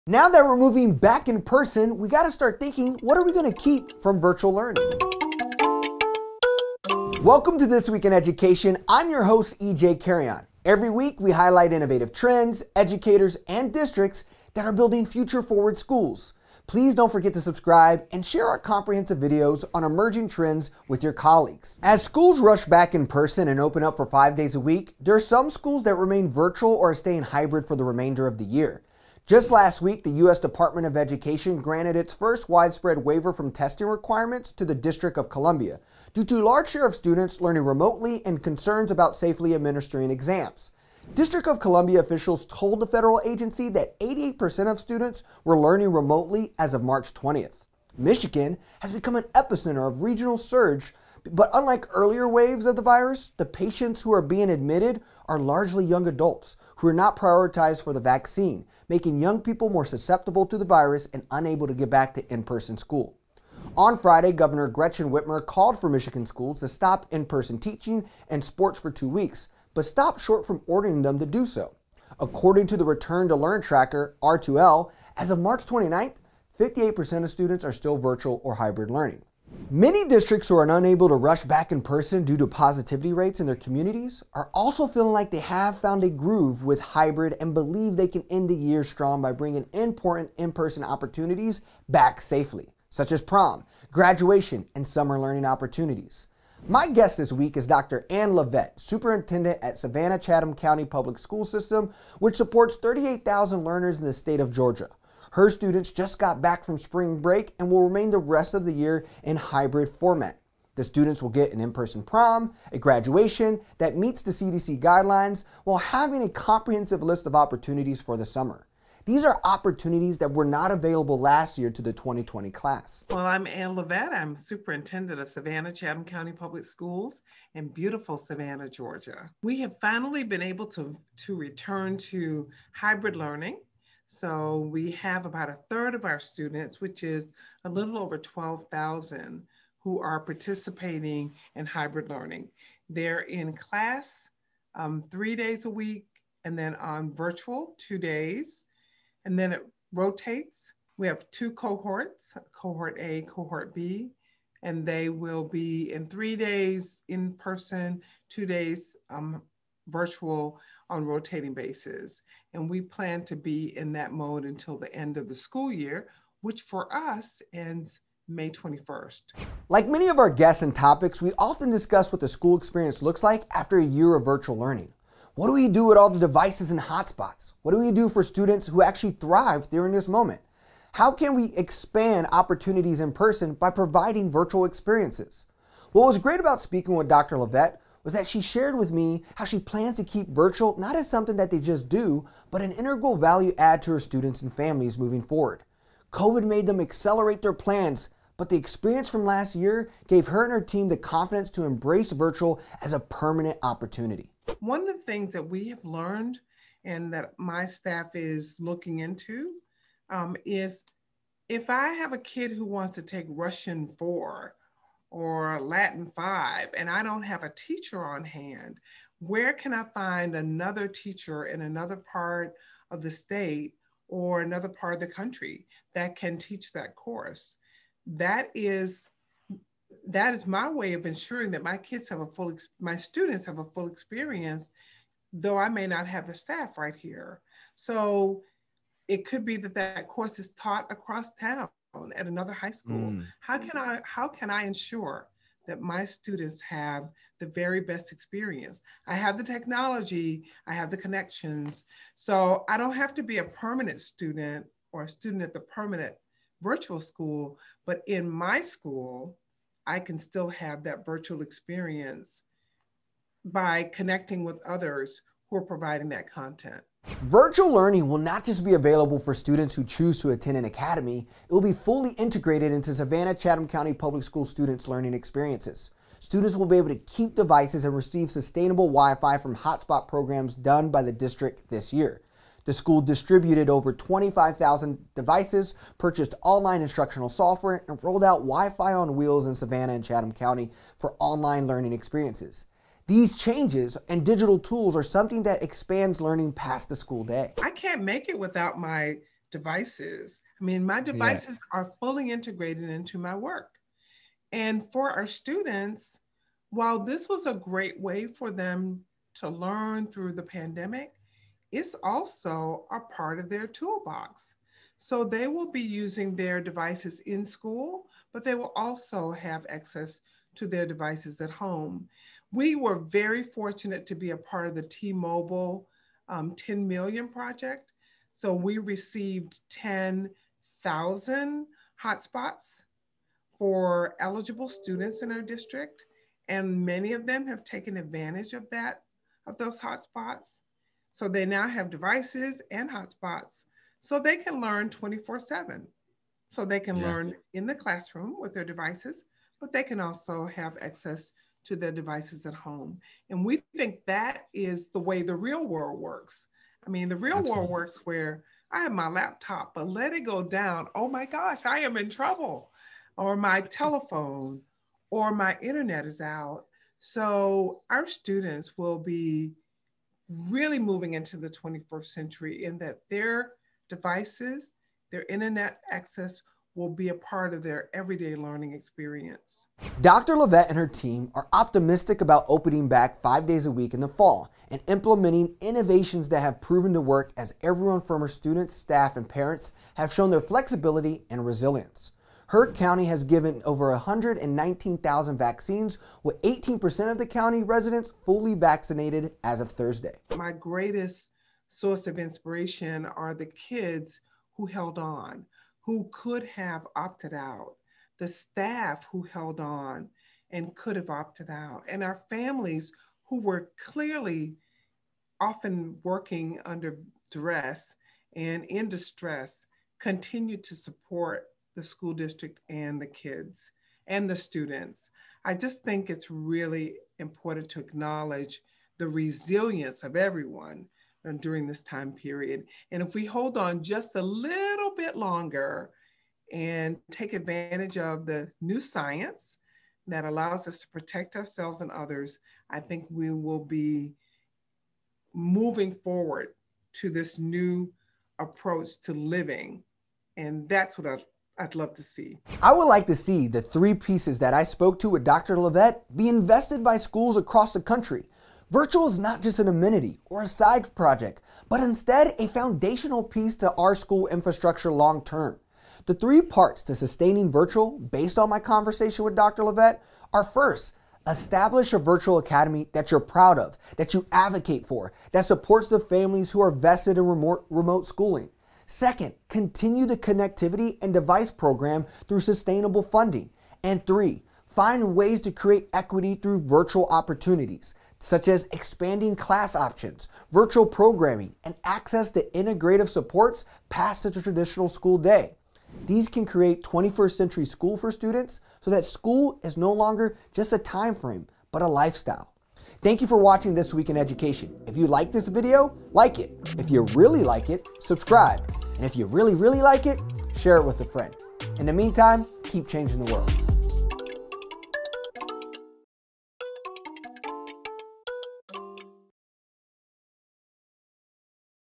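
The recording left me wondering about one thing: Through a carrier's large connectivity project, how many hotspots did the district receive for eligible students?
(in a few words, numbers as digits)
10,000.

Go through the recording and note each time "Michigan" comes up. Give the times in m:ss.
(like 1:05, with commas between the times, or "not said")
0:47, 1:05.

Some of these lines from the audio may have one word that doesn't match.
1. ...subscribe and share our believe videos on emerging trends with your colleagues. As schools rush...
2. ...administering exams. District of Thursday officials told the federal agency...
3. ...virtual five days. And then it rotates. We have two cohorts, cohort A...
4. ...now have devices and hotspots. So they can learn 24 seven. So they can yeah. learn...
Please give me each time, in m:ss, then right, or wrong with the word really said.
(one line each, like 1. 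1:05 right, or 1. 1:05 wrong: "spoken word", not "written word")
1. 0:17 wrong: "comprehensive", not "believe"
2. 0:39 wrong: "Columbia", not "Thursday"
3. 2:27 wrong: "two", not "five"
4. 5:41 right.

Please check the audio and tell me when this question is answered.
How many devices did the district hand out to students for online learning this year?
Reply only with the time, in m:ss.
4:43.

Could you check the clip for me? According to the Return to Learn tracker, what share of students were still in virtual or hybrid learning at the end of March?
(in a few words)
58%.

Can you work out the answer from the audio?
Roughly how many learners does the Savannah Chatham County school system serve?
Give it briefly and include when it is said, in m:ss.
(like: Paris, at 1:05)
38,000, at 1:42.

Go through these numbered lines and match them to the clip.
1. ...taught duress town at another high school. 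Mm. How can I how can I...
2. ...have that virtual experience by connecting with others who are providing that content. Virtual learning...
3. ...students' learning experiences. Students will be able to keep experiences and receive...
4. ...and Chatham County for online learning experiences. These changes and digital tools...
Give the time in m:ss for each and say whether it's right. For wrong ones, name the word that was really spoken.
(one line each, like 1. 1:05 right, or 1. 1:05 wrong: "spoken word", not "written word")
1. 4:00 wrong: "across", not "duress"
2. 4:20 right
3. 4:34 wrong: "devices", not "experiences"
4. 4:49 right.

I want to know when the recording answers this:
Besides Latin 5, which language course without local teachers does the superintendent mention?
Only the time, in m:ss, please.
3:33.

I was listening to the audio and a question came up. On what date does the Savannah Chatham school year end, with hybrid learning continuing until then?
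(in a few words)
May 21st.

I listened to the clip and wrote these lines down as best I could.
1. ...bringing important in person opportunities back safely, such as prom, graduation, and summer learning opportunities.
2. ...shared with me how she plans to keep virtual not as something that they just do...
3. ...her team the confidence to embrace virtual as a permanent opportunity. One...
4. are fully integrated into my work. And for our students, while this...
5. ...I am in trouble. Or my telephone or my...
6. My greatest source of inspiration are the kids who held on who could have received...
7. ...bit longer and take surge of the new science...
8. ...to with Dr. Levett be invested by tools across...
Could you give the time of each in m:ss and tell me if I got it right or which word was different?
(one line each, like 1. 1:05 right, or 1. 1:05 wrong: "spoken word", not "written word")
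1. 1:29 right
2. 3:08 right
3. 3:20 right
4. 5:01 right
5. 6:01 right
6. 6:40 wrong: "opted", not "received"
7. 7:15 wrong: "advantage", not "surge"
8. 7:34 wrong: "schools", not "tools".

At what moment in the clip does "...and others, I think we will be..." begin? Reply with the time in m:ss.
7:21.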